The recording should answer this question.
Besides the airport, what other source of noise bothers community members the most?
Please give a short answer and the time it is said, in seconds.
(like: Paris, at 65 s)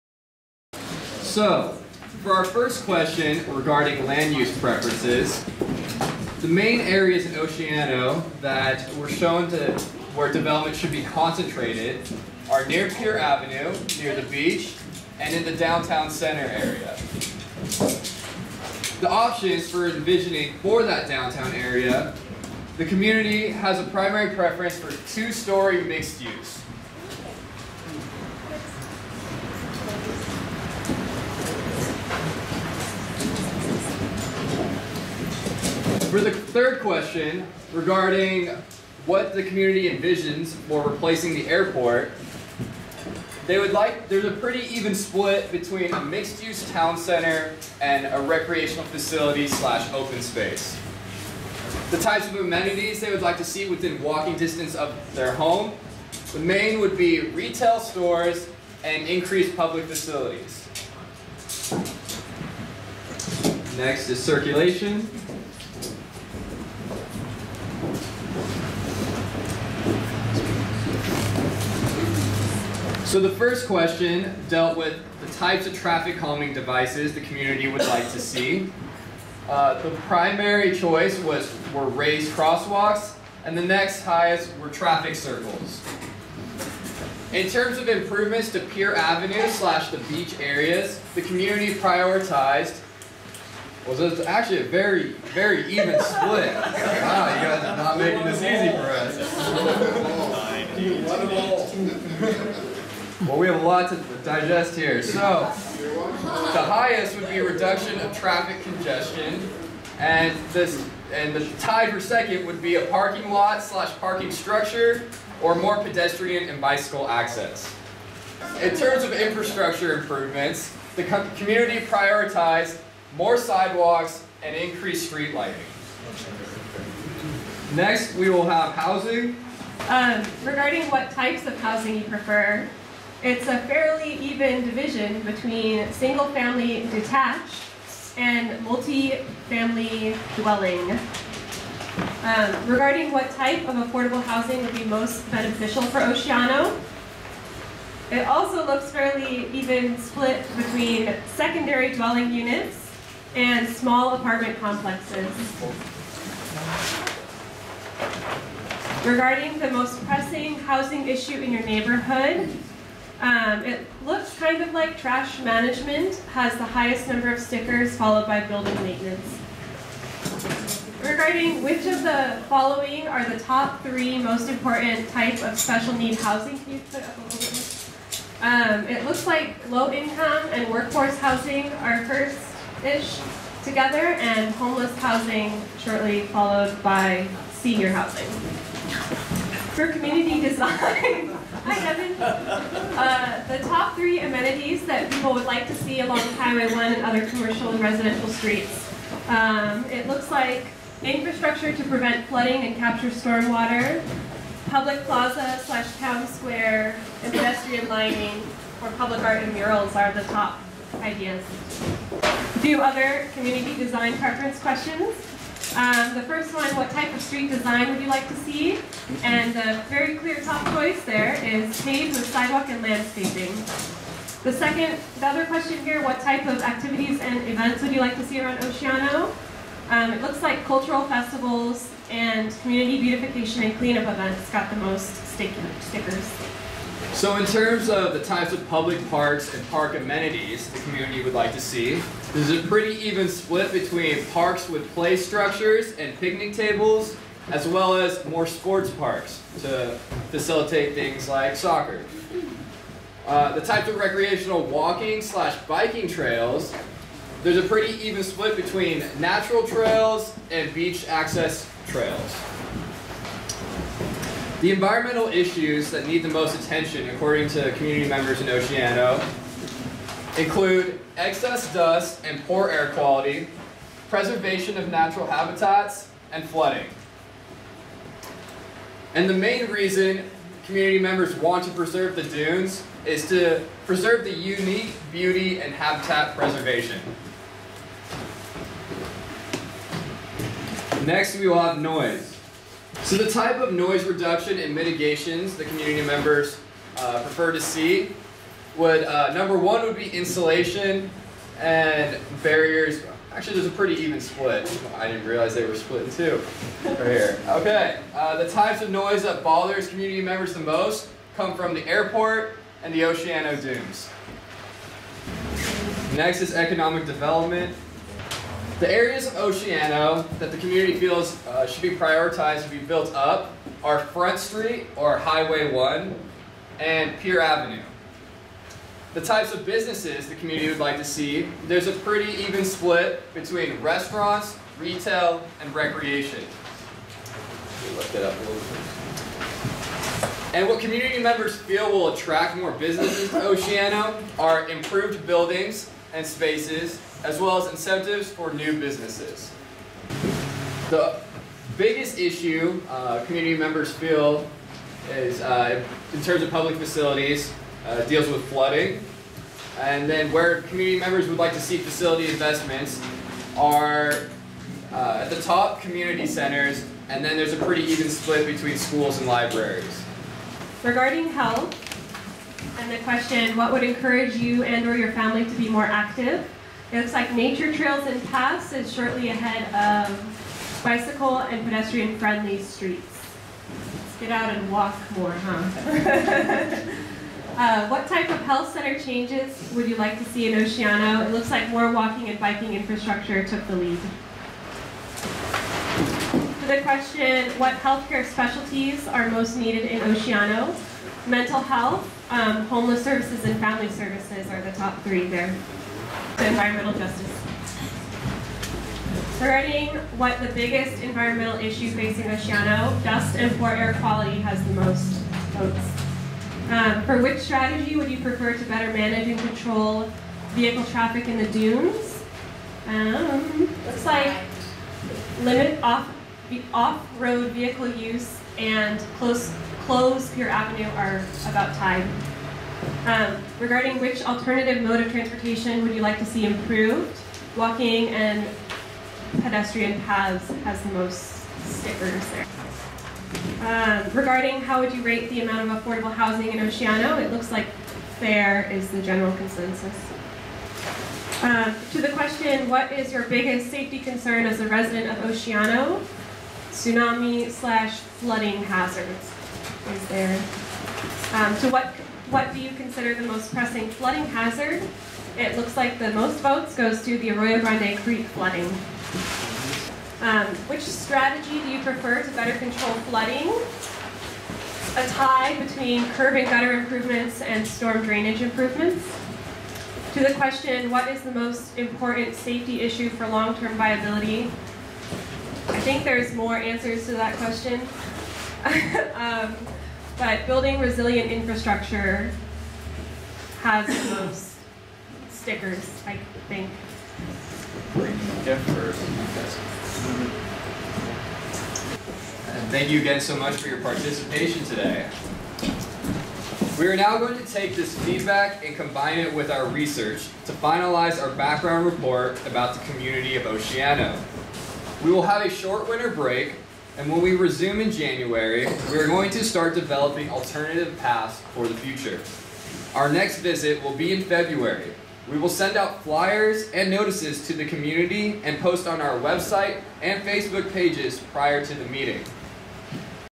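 The Oceano Dunes, at 313 s.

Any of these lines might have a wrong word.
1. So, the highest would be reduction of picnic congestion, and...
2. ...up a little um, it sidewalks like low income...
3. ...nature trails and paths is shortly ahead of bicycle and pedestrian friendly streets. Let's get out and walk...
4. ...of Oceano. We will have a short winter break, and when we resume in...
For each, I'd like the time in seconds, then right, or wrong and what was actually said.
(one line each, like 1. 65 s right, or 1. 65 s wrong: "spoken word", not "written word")
1. 105 s wrong: "traffic", not "picnic"
2. 177 s wrong: "looks", not "sidewalks"
3. 377 s right
4. 513 s right.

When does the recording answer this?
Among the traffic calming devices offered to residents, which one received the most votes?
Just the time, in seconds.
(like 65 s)
81 s.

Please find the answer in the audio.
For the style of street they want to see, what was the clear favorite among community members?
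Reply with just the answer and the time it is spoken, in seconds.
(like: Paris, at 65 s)
Paved with sidewalk and landscaping, at 221 s.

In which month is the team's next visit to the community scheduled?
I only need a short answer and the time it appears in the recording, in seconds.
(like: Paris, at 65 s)
February, at 524 s.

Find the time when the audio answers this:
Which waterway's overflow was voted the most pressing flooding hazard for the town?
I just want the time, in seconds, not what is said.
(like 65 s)
467 s.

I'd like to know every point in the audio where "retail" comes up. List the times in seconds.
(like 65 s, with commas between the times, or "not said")
57 s, 334 s.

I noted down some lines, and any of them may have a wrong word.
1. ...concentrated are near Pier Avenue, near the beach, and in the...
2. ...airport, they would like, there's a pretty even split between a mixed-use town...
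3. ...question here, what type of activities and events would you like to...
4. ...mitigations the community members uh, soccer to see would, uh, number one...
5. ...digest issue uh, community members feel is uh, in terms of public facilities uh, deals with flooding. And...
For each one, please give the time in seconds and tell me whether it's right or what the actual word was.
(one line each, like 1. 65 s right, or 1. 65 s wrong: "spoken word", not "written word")
1. 11 s right
2. 41 s right
3. 225 s right
4. 294 s wrong: "prefer", not "soccer"
5. 351 s wrong: "biggest", not "digest".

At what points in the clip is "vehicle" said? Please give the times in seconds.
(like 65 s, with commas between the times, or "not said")
420 s, 427 s.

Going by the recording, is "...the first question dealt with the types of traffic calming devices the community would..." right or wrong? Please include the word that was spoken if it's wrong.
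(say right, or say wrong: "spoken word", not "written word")
right.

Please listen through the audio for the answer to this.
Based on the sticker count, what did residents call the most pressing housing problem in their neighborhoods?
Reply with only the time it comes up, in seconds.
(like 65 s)
164 s.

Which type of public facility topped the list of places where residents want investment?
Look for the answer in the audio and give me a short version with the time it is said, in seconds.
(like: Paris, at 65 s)
Community centers, at 365 s.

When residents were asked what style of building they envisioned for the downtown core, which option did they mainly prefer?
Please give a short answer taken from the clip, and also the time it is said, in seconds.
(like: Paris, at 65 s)
Two-story mixed use, at 25 s.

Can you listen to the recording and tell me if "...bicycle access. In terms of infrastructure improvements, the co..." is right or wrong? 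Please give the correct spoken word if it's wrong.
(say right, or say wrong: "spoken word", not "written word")
right.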